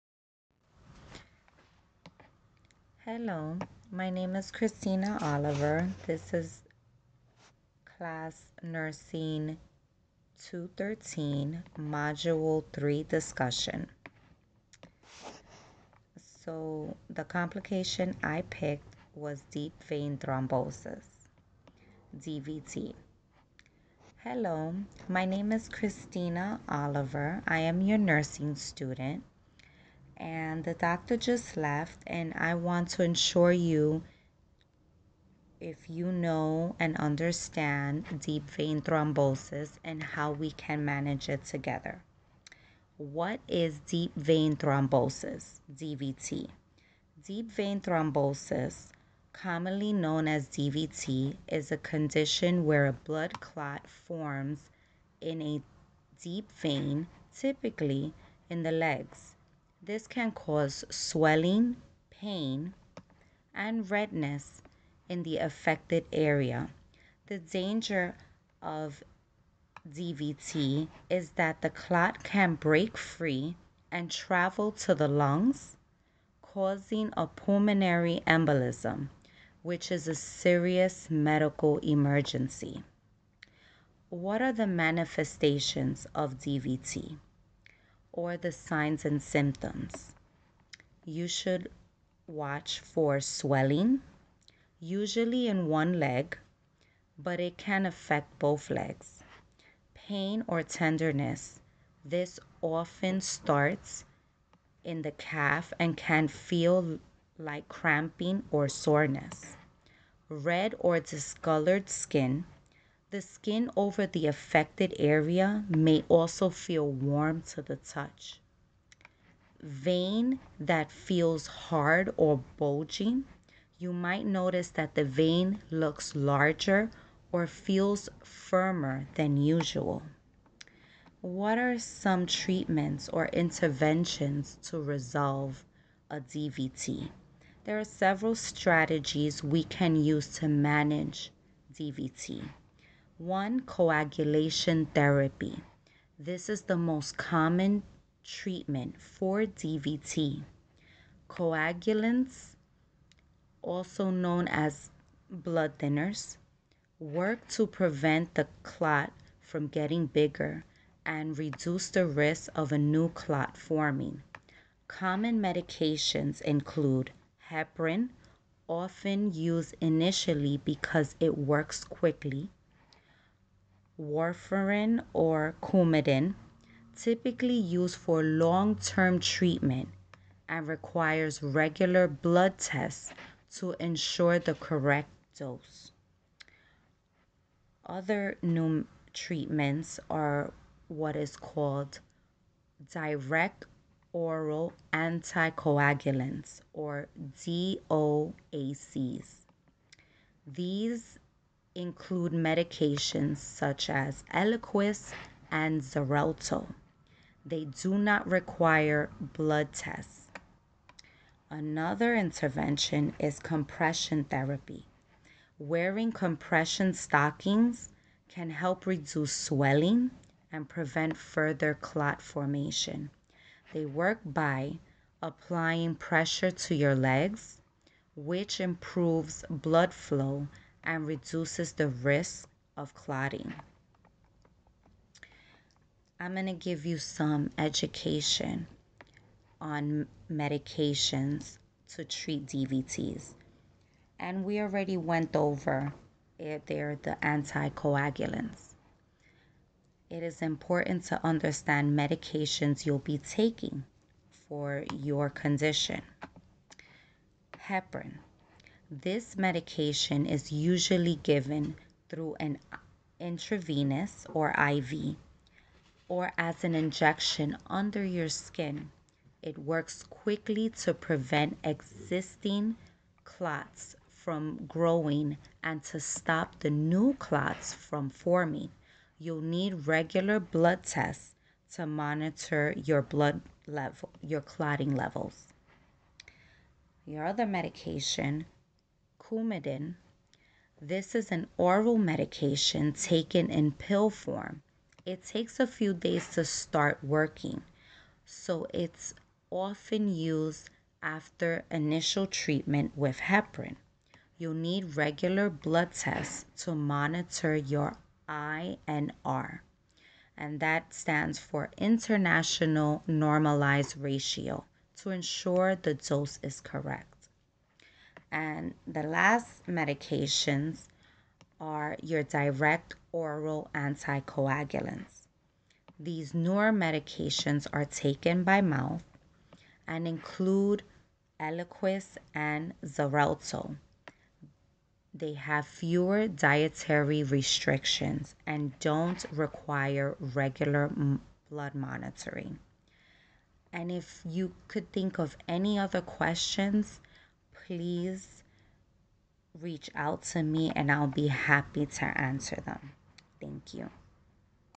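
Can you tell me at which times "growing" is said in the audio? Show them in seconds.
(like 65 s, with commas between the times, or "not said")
274 s.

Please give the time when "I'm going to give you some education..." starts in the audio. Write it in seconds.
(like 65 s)
236 s.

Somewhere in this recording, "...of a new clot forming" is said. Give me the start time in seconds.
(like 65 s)
162 s.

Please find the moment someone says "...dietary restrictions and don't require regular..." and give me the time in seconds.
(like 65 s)
336 s.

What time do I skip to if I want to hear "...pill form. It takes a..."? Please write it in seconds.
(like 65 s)
293 s.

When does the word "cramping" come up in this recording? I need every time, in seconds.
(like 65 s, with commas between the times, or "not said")
107 s.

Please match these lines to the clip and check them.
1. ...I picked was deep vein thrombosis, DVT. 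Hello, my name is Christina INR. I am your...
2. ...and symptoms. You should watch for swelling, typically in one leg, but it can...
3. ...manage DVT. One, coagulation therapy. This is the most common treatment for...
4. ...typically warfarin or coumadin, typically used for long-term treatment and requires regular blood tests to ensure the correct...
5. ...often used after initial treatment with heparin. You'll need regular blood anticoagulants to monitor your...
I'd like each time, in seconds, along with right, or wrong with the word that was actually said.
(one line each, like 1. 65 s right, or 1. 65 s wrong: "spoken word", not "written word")
1. 18 s wrong: "Oliver", not "INR"
2. 89 s wrong: "usually", not "typically"
3. 140 s right
4. 171 s wrong: "quickly", not "typically"
5. 299 s wrong: "tests", not "anticoagulants".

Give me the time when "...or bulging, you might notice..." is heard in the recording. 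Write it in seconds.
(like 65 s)
122 s.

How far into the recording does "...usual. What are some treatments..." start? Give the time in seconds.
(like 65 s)
129 s.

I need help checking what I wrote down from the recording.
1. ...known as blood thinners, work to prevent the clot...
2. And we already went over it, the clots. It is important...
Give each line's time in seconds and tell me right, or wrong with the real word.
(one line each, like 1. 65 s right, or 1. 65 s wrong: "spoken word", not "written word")
1. 154 s right
2. 244 s wrong: "anticoagulants", not "clots".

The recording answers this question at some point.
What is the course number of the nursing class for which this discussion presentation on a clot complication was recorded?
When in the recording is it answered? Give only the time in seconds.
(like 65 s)
10 s.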